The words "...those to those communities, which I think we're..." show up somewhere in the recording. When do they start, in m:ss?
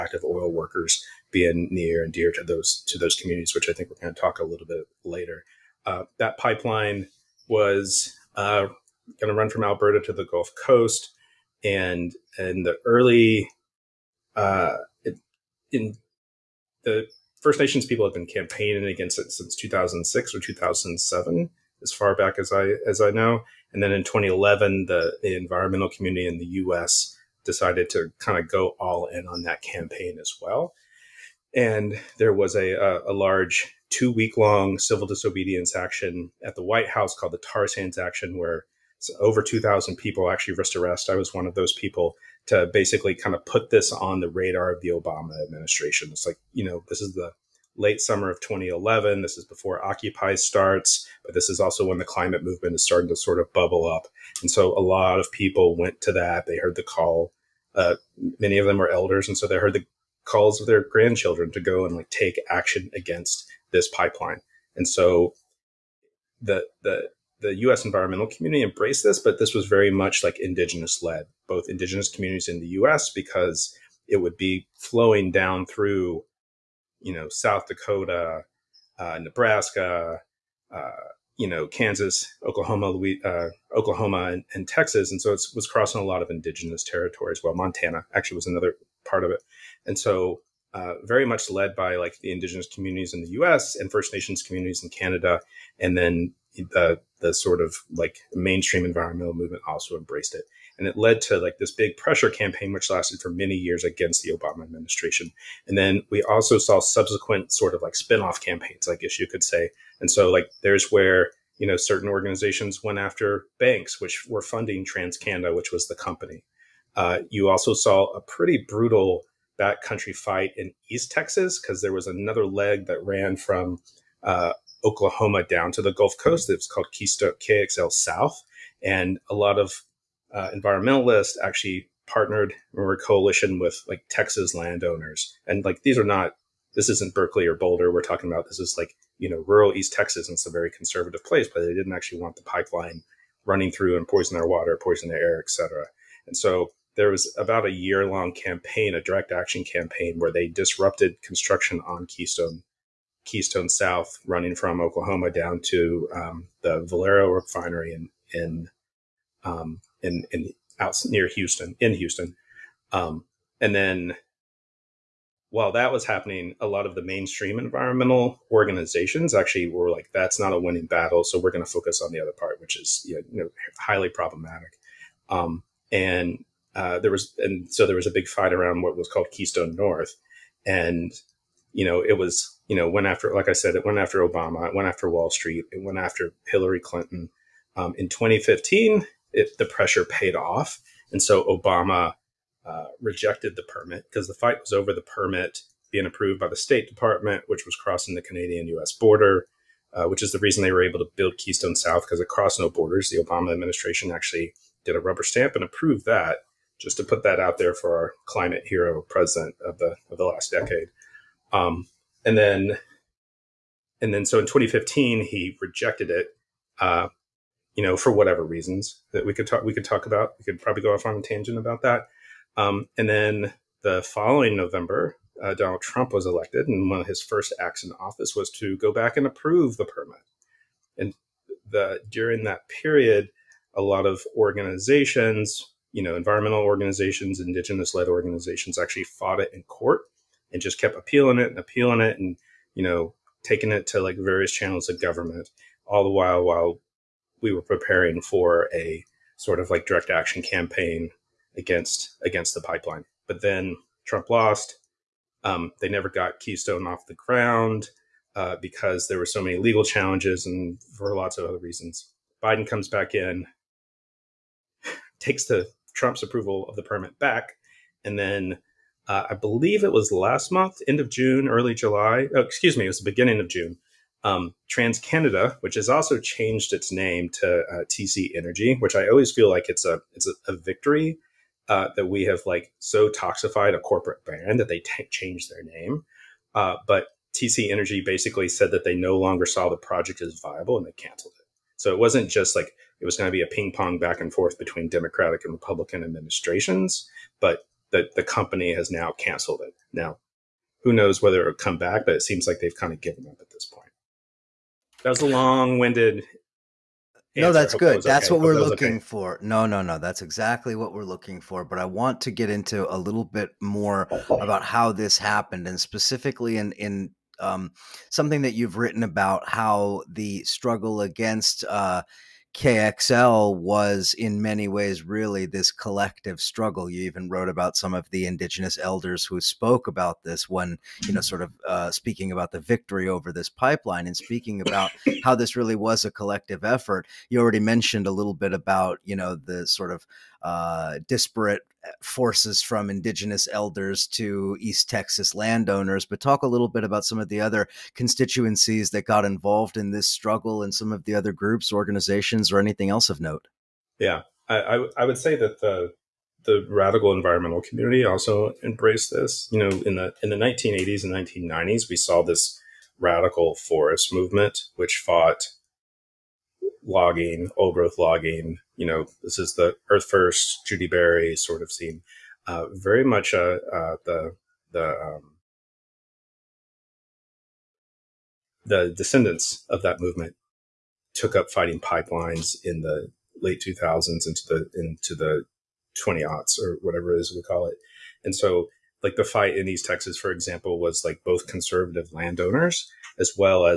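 0:02.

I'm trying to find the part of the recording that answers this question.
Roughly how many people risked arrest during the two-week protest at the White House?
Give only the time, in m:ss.
0:39.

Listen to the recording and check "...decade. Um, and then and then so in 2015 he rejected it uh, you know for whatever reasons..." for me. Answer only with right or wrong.
right.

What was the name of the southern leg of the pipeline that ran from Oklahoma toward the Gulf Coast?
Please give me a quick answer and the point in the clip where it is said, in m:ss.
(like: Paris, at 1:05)
Keystone KXL South, at 2:06.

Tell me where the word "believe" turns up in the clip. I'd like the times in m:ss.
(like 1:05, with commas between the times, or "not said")
4:29.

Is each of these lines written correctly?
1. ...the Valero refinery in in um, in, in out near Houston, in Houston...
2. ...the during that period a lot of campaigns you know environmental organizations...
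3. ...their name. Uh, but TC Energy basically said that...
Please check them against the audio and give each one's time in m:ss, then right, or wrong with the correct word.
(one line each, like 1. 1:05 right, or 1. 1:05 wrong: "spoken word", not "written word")
1. 2:36 right
2. 3:51 wrong: "organizations", not "campaigns"
3. 4:45 right.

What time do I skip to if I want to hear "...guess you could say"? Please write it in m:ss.
1:48.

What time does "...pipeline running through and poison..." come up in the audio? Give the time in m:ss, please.
2:22.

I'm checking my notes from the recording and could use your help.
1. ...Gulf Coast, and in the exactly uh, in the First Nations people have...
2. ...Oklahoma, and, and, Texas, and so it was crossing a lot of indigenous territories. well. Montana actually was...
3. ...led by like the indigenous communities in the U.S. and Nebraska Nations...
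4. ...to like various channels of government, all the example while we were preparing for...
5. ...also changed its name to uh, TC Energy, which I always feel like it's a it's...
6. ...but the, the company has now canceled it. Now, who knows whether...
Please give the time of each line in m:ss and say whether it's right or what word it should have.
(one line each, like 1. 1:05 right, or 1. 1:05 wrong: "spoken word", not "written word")
1. 0:10 wrong: "early", not "exactly"
2. 1:23 right
3. 1:31 wrong: "First", not "Nebraska"
4. 4:03 wrong: "while", not "example"
5. 4:35 right
6. 4:57 right.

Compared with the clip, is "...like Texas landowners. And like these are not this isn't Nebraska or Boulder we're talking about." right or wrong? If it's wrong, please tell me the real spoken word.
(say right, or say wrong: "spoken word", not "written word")
wrong: "Berkeley", not "Nebraska".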